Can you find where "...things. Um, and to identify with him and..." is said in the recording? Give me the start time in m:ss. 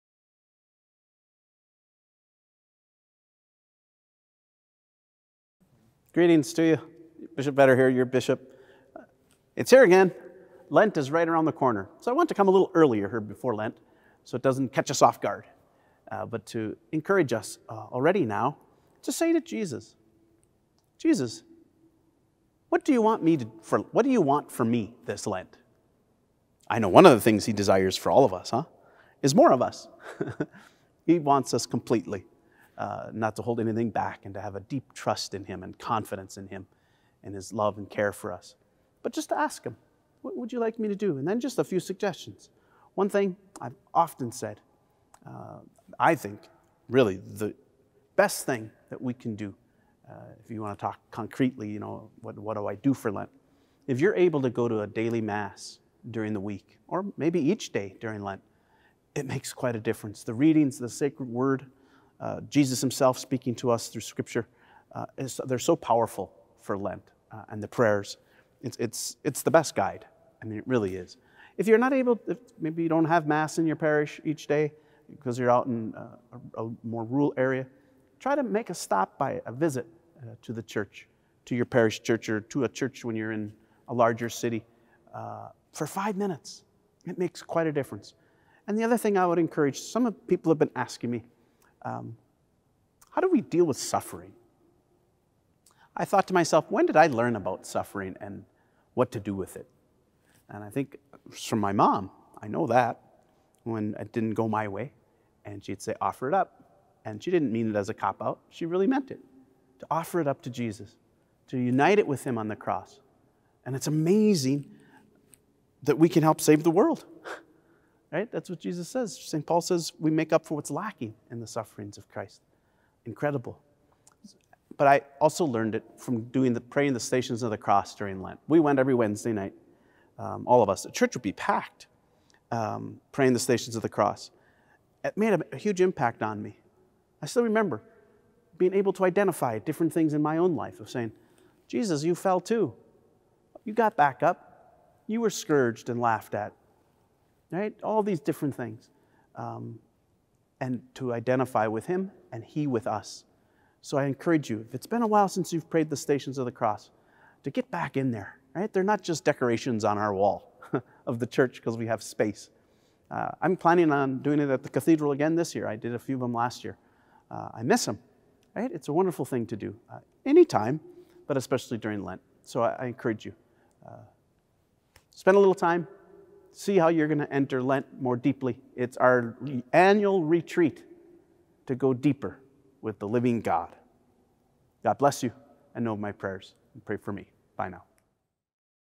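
2:28.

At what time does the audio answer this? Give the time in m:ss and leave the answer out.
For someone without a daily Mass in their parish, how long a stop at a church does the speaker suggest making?
1:25.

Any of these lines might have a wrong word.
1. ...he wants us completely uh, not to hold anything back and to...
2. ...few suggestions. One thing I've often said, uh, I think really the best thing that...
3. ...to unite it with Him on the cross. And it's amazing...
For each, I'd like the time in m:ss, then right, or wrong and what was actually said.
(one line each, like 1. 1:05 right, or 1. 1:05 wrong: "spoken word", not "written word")
1. 0:31 right
2. 0:41 right
3. 1:51 right.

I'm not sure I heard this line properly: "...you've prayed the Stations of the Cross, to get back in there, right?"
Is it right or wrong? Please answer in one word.
right.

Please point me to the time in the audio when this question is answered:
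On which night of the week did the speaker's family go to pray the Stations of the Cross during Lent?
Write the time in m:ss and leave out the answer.
2:08.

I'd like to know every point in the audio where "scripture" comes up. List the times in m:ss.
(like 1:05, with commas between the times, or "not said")
1:04.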